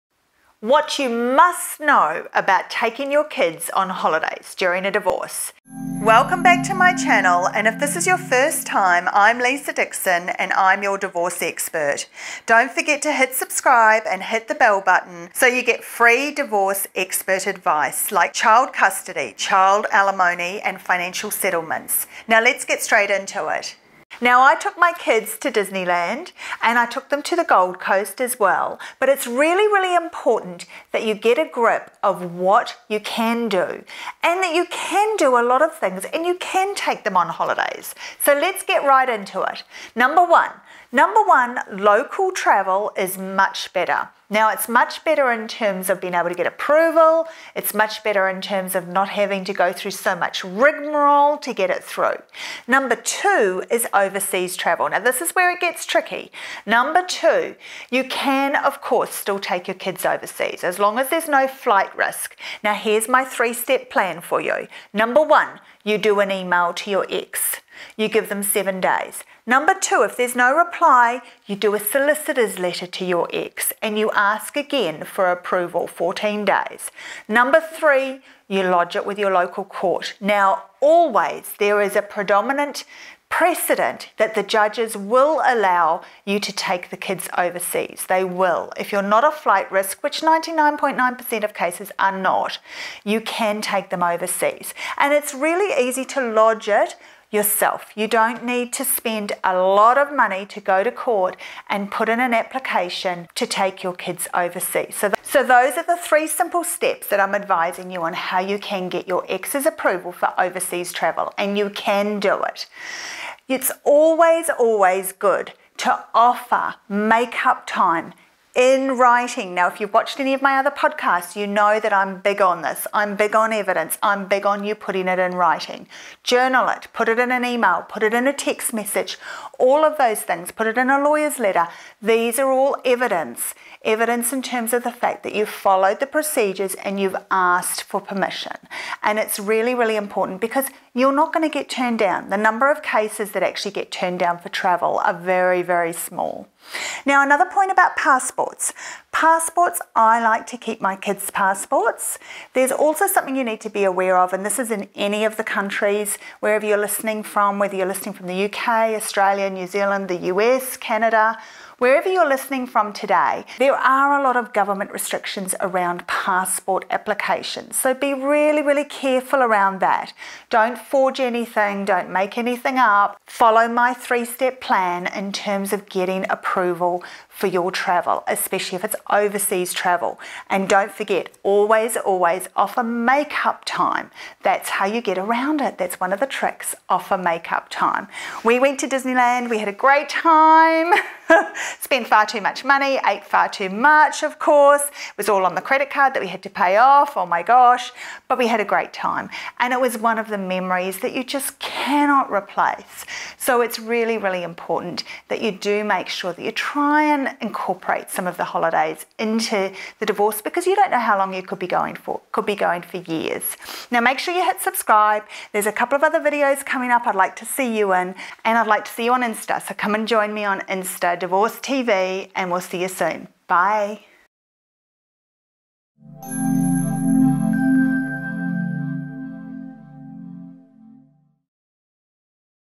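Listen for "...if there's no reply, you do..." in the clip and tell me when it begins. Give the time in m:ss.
1:10.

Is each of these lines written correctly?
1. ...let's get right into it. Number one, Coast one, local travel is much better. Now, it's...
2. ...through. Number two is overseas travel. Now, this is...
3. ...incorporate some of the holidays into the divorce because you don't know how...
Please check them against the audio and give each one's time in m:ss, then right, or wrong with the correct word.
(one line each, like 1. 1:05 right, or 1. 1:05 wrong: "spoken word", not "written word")
1. 0:38 wrong: "Number", not "Coast"
2. 0:51 right
3. 3:27 right.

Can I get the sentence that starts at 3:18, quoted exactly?
But we had a great time.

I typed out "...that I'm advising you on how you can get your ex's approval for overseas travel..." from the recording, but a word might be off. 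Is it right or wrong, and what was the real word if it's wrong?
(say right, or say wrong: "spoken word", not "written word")
right.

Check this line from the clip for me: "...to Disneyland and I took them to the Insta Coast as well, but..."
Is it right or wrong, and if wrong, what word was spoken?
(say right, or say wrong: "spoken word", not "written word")
wrong: "Gold", not "Insta".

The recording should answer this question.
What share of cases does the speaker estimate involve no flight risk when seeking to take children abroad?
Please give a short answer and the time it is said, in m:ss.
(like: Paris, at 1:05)
99.9%, at 1:30.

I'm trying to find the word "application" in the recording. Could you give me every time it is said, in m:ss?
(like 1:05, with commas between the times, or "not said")
1:42, 2:46.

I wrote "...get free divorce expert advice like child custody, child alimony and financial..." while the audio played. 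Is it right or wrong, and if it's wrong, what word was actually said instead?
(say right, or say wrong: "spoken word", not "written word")
right.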